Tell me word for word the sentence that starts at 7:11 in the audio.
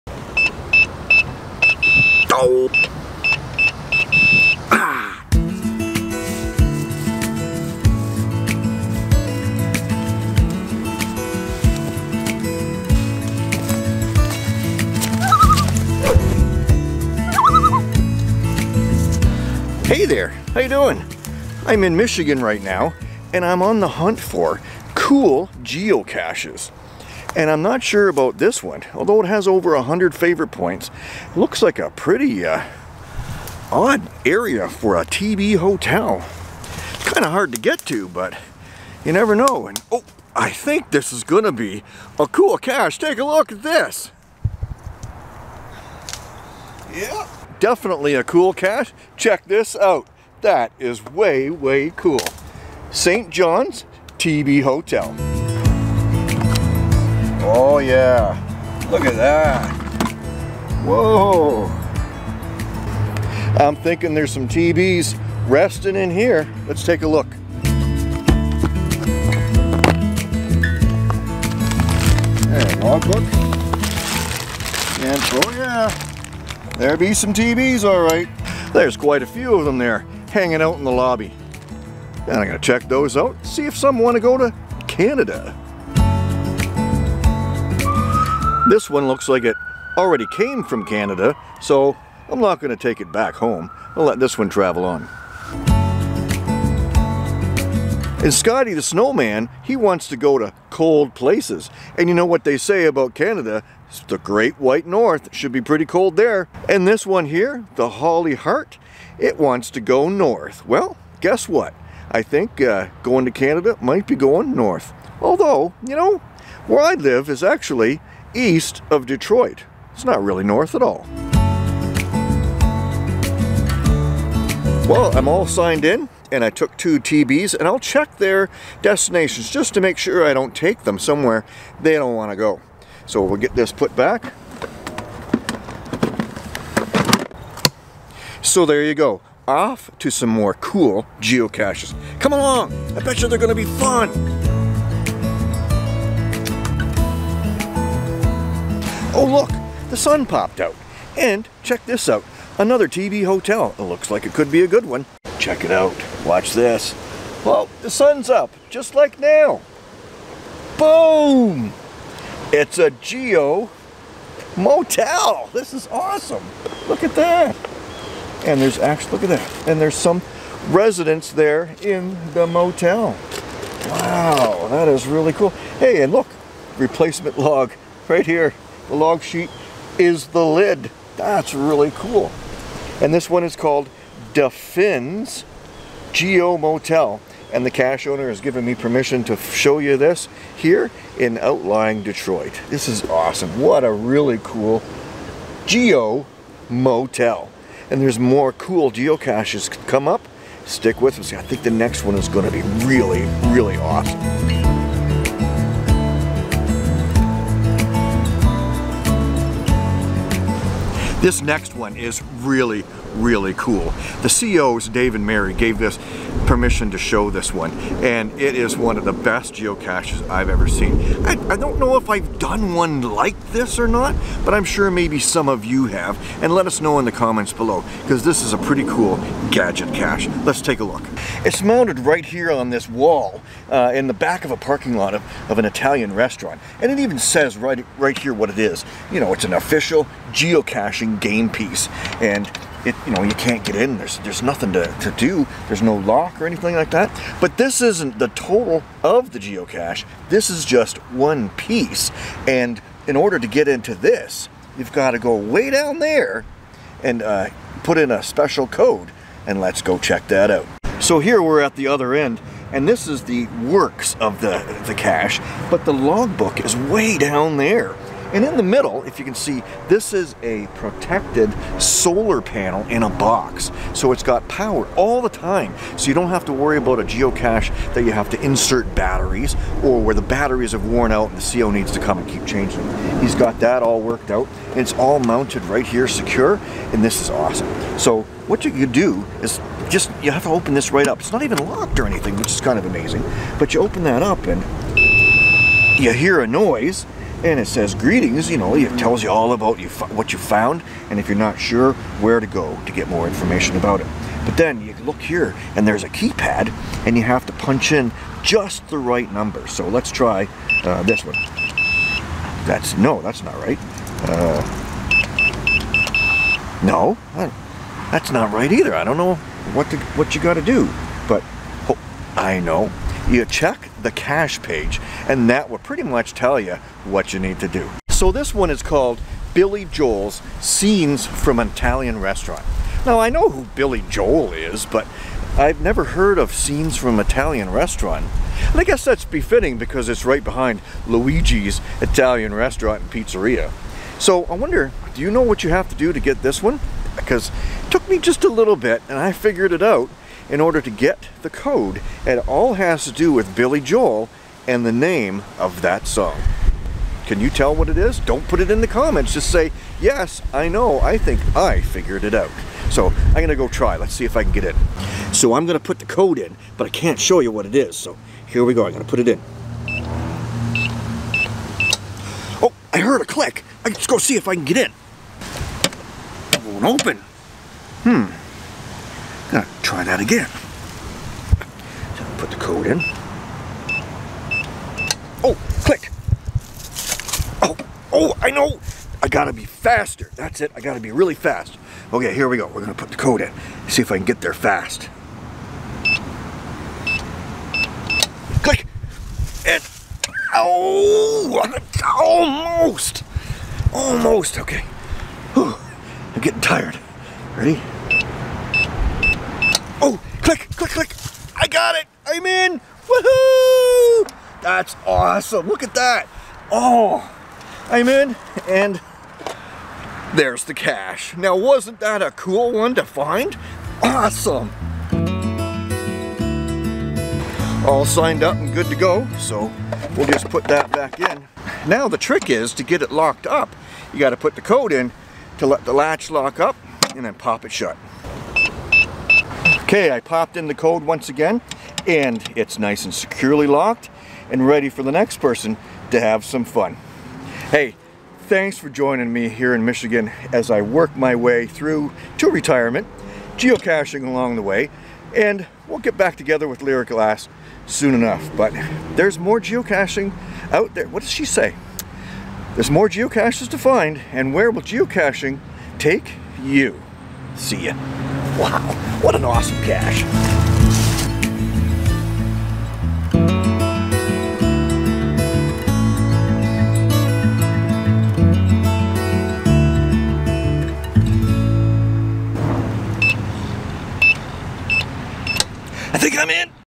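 Now the trick is to get it locked up.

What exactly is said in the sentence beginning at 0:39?
And oh, I think this is going to be a cool cache.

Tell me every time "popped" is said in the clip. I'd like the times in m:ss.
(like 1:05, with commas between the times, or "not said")
2:30, 7:20.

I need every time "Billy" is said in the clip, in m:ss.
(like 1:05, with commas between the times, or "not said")
5:29, 5:33, 5:53.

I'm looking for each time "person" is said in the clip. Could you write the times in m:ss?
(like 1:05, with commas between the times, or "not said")
7:25.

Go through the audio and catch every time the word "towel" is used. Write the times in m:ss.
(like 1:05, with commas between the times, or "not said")
not said.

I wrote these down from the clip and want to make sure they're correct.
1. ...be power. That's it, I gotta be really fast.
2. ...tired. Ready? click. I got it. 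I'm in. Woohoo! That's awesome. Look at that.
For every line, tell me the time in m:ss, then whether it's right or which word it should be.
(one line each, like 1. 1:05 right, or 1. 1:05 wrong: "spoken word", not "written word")
1. 6:29 wrong: "faster", not "power"
2. 6:46 right.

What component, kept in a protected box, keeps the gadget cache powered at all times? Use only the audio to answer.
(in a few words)
solar panel.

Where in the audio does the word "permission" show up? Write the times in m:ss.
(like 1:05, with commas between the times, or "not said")
3:08, 3:36.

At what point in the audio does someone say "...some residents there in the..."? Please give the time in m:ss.
2:49.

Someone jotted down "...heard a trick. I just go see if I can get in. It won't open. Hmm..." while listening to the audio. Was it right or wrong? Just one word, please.
wrong.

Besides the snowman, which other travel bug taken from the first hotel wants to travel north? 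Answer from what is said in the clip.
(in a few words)
Holly Heart.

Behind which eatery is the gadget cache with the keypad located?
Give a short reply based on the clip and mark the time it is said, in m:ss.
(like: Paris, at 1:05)
Luigi's Italian Restaurant and Pizzeria, at 5:41.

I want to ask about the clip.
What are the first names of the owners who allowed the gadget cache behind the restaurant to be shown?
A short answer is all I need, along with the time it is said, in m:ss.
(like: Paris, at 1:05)
Dave and Mary, at 3:34.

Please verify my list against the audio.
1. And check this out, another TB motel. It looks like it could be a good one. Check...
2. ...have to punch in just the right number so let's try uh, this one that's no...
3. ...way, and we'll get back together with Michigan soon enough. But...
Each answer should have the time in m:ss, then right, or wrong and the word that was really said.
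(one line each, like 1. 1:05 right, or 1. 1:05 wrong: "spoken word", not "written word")
1. 2:31 wrong: "hotel", not "motel"
2. 5:07 right
3. 7:34 wrong: "Lyriclass", not "Michigan".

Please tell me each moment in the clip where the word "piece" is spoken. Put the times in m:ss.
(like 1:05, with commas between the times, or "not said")
4:01, 4:11.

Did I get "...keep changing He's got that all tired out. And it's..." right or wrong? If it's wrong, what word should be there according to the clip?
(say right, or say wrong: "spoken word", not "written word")
wrong: "worked", not "tired".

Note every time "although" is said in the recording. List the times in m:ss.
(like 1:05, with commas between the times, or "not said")
0:28, 1:55.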